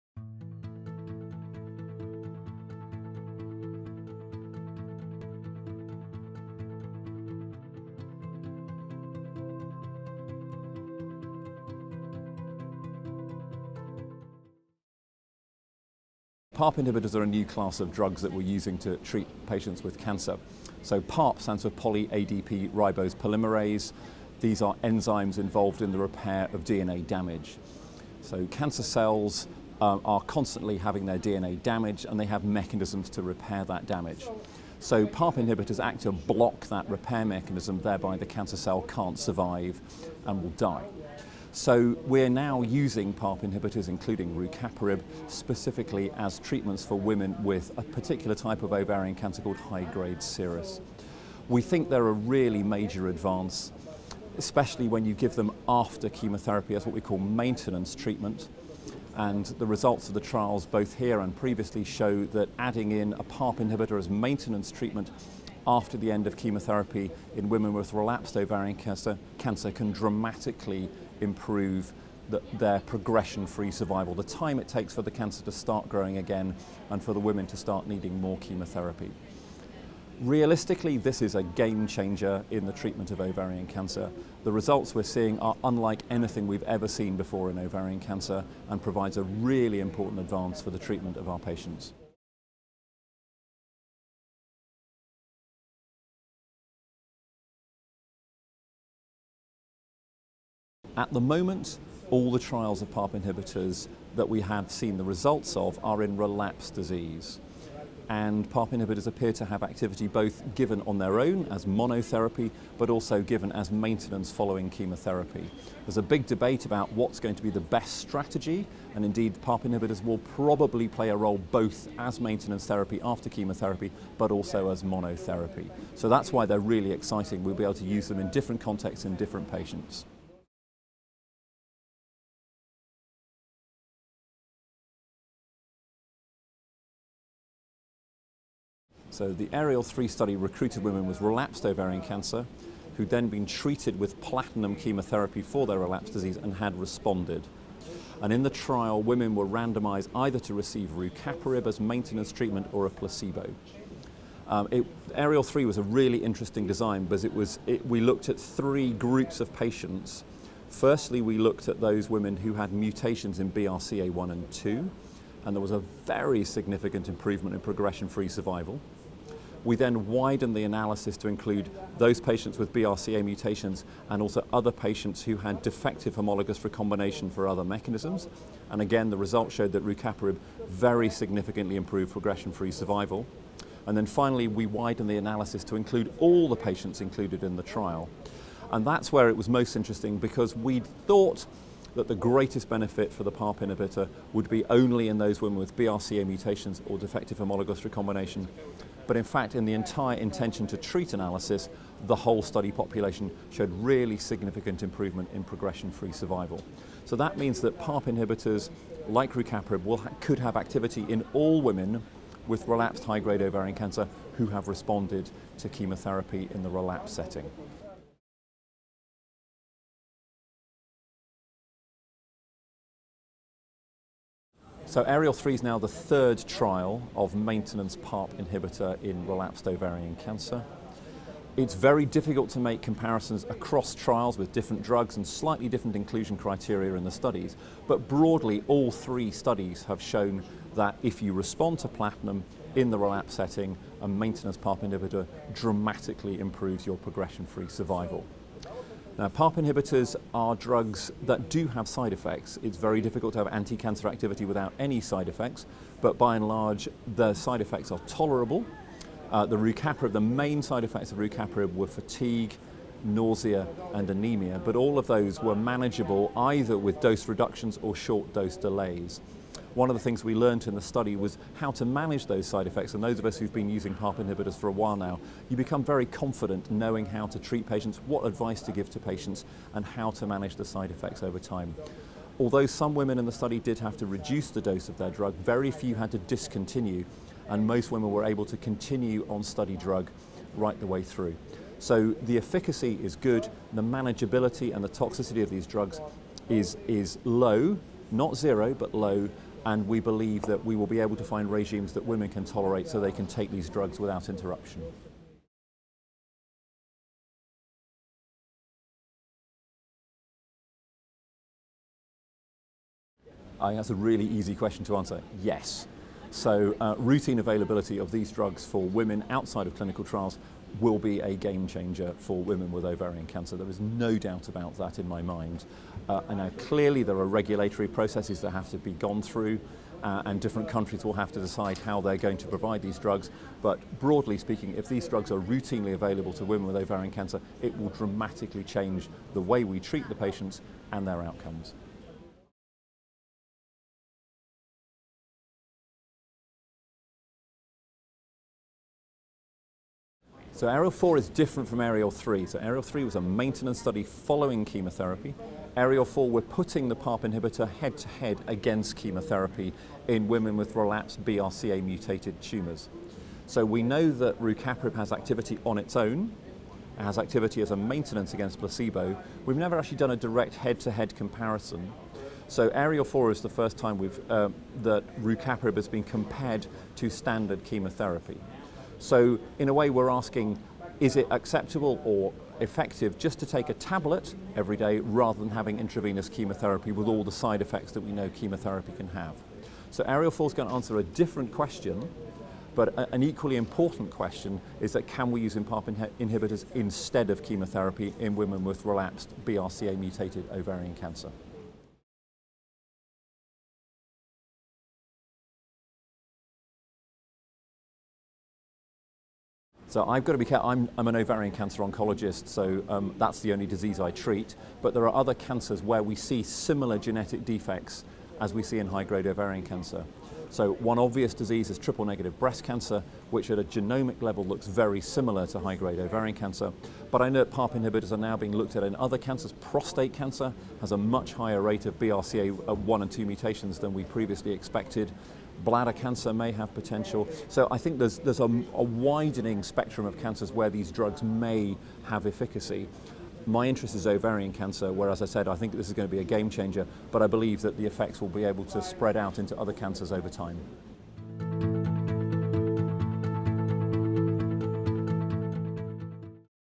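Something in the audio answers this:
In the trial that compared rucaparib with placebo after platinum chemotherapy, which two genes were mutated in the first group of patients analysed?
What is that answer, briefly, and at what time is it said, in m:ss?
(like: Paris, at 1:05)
BRCA1 and 2, at 2:43.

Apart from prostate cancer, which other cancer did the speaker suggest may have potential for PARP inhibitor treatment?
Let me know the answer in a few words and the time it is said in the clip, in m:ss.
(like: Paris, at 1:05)
bladder cancer, at 7:15.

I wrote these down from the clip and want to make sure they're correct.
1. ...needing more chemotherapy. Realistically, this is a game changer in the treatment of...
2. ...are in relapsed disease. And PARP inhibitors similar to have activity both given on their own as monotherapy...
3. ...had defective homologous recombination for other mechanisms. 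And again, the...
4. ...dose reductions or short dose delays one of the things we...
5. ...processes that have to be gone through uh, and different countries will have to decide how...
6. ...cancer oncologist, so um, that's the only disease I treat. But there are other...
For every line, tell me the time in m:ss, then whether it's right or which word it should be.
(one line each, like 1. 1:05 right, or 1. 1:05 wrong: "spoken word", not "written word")
1. 1:17 right
2. 1:45 wrong: "appear", not "similar"
3. 2:55 right
4. 4:26 right
5. 5:27 right
6. 6:51 right.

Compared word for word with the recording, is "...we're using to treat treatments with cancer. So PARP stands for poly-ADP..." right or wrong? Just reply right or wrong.
wrong.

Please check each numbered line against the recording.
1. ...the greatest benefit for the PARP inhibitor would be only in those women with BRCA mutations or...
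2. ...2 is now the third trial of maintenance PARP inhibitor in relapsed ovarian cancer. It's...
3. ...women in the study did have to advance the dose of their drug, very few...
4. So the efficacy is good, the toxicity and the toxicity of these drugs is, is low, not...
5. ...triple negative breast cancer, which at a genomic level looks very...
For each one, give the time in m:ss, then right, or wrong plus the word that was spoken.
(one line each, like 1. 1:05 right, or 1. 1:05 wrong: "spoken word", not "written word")
1. 3:12 right
2. 3:45 wrong: "3", not "2"
3. 4:42 wrong: "reduce", not "advance"
4. 4:51 wrong: "manageability", not "toxicity"
5. 7:01 right.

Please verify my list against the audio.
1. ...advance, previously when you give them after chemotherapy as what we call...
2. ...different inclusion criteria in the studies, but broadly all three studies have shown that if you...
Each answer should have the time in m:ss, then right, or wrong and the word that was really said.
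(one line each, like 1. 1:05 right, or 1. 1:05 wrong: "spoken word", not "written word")
1. 0:53 wrong: "especially", not "previously"
2. 3:55 right.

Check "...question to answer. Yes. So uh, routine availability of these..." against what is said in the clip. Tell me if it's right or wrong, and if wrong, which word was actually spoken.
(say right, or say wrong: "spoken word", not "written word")
right.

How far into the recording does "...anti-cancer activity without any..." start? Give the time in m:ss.
4:13.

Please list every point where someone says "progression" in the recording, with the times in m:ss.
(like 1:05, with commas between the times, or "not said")
1:12, 2:47, 3:02, 3:25, 4:06.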